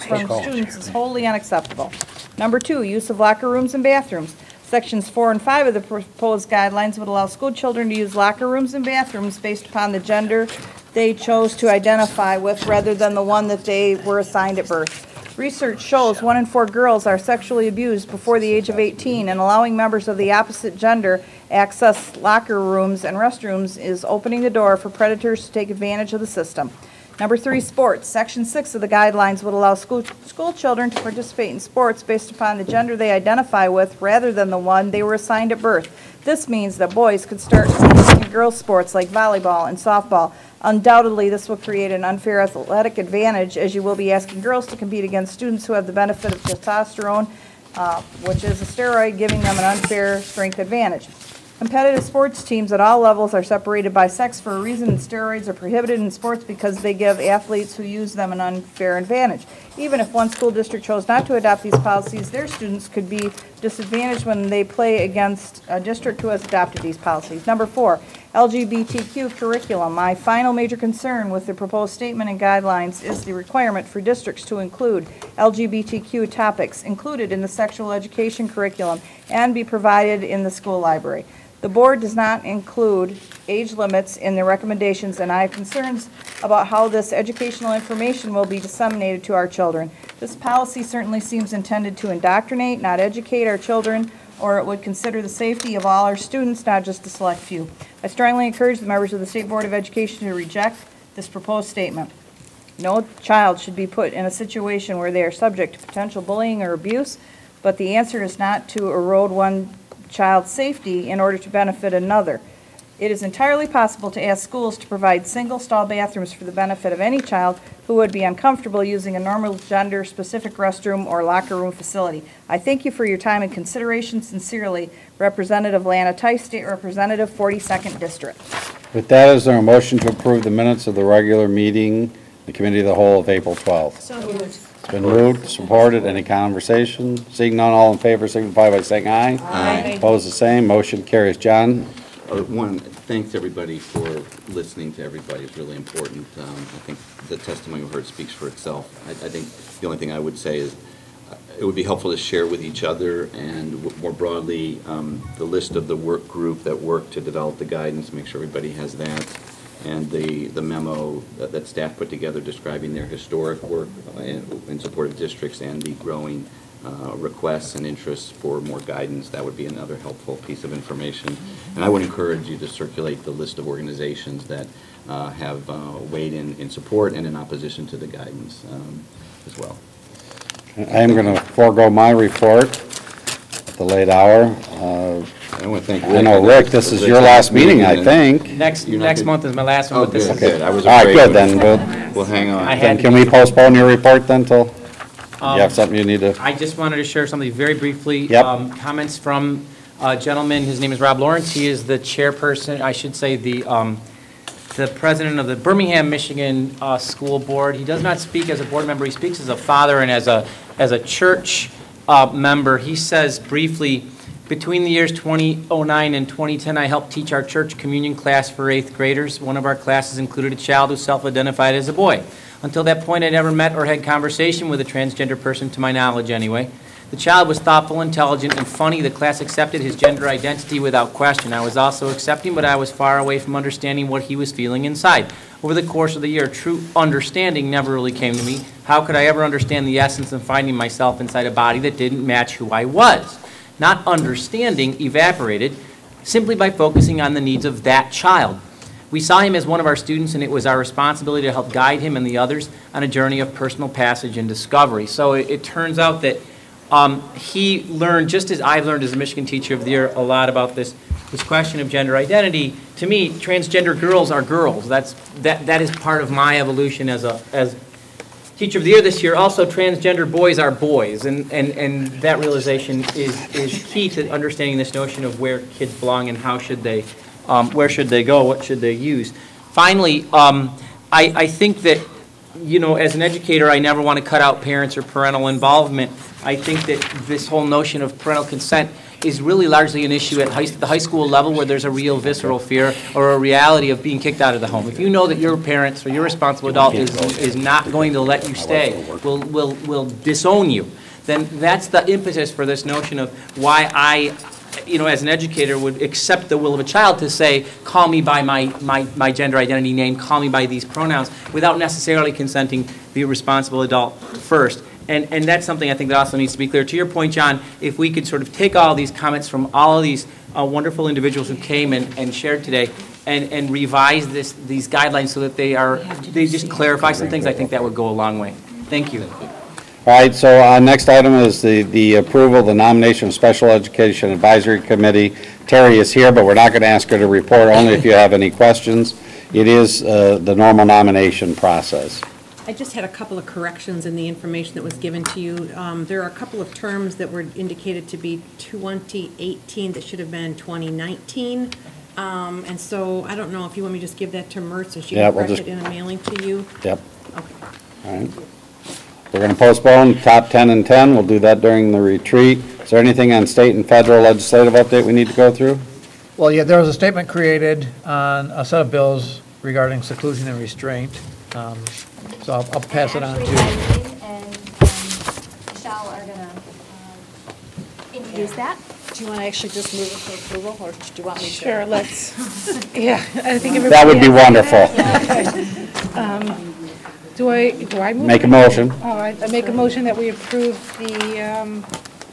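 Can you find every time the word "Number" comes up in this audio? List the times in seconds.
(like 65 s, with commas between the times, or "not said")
2 s, 27 s, 67 s.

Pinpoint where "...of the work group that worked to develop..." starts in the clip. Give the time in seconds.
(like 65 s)
155 s.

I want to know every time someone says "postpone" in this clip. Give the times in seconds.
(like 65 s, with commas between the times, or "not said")
193 s, 359 s.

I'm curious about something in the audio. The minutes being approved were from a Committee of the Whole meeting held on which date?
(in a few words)
April 12th.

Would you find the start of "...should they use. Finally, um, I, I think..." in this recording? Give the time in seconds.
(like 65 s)
278 s.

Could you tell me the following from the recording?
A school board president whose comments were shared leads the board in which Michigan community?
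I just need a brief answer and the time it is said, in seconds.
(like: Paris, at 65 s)
Birmingham, at 205 s.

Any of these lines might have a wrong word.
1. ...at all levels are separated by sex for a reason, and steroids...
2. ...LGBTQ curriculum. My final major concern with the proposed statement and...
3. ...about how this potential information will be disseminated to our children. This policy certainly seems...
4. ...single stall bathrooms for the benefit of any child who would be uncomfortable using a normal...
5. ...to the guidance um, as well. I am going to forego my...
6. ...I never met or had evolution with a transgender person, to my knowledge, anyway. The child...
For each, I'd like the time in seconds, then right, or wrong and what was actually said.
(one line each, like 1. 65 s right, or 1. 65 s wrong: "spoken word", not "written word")
1. 52 s right
2. 68 s right
3. 86 s wrong: "educational", not "potential"
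4. 115 s right
5. 177 s right
6. 223 s wrong: "conversation", not "evolution".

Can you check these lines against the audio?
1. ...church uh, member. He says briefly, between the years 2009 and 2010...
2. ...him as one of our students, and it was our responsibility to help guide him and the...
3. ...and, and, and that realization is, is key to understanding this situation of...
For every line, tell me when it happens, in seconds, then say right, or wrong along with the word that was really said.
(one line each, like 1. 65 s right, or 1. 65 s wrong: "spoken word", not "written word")
1. 210 s right
2. 249 s right
3. 271 s wrong: "notion", not "situation".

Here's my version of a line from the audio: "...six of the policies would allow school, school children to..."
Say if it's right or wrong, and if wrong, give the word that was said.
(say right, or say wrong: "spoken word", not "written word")
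wrong: "guidelines", not "policies".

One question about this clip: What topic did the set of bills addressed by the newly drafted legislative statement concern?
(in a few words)
seclusion and restraint.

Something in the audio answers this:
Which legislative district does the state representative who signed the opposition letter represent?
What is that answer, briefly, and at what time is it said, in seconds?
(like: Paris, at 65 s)
42nd District, at 127 s.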